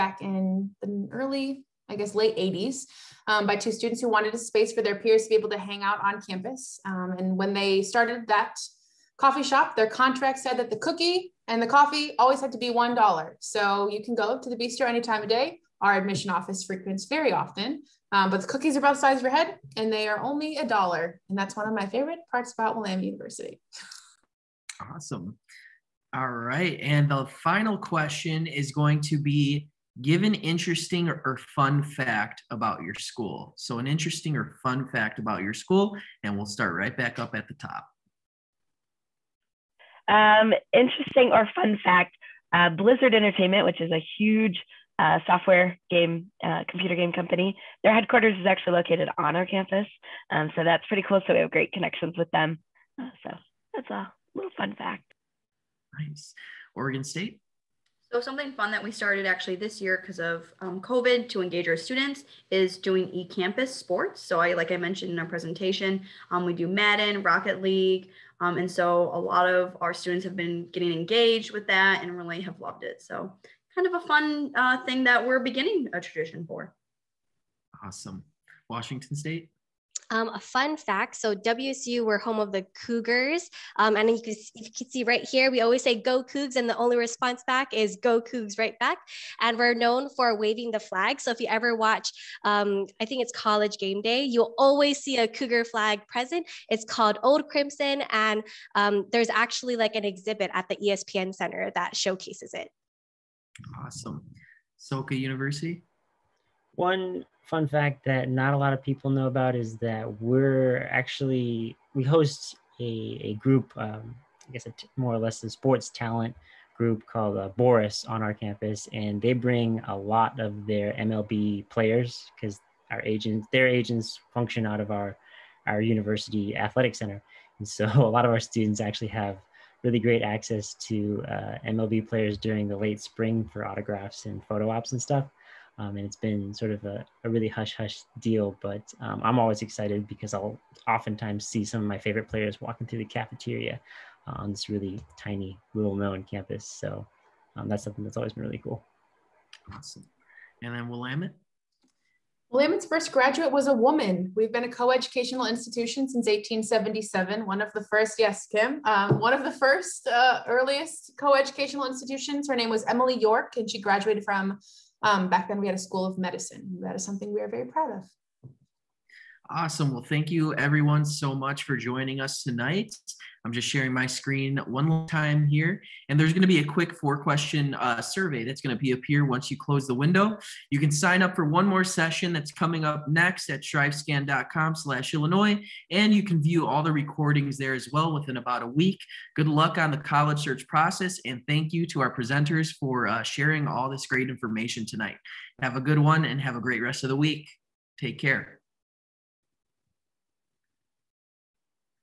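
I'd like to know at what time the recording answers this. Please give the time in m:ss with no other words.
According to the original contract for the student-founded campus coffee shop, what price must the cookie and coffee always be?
0:12.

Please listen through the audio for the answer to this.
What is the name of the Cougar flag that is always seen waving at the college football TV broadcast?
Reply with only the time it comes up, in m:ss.
1:37.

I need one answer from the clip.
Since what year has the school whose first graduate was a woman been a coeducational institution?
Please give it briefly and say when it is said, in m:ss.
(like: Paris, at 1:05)
1877, at 2:36.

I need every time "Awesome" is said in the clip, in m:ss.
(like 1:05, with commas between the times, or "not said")
0:24, 1:17, 1:43, 2:29, 2:49.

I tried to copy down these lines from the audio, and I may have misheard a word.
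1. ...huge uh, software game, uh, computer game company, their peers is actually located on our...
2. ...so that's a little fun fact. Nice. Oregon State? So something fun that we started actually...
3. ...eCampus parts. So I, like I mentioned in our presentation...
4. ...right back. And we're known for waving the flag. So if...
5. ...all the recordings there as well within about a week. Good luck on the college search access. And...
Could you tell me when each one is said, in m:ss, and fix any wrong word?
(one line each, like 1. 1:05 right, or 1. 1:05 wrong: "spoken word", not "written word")
1. 0:44 wrong: "headquarters", not "peers"
2. 0:53 right
3. 1:03 wrong: "sports", not "parts"
4. 1:28 right
5. 3:06 wrong: "process", not "access".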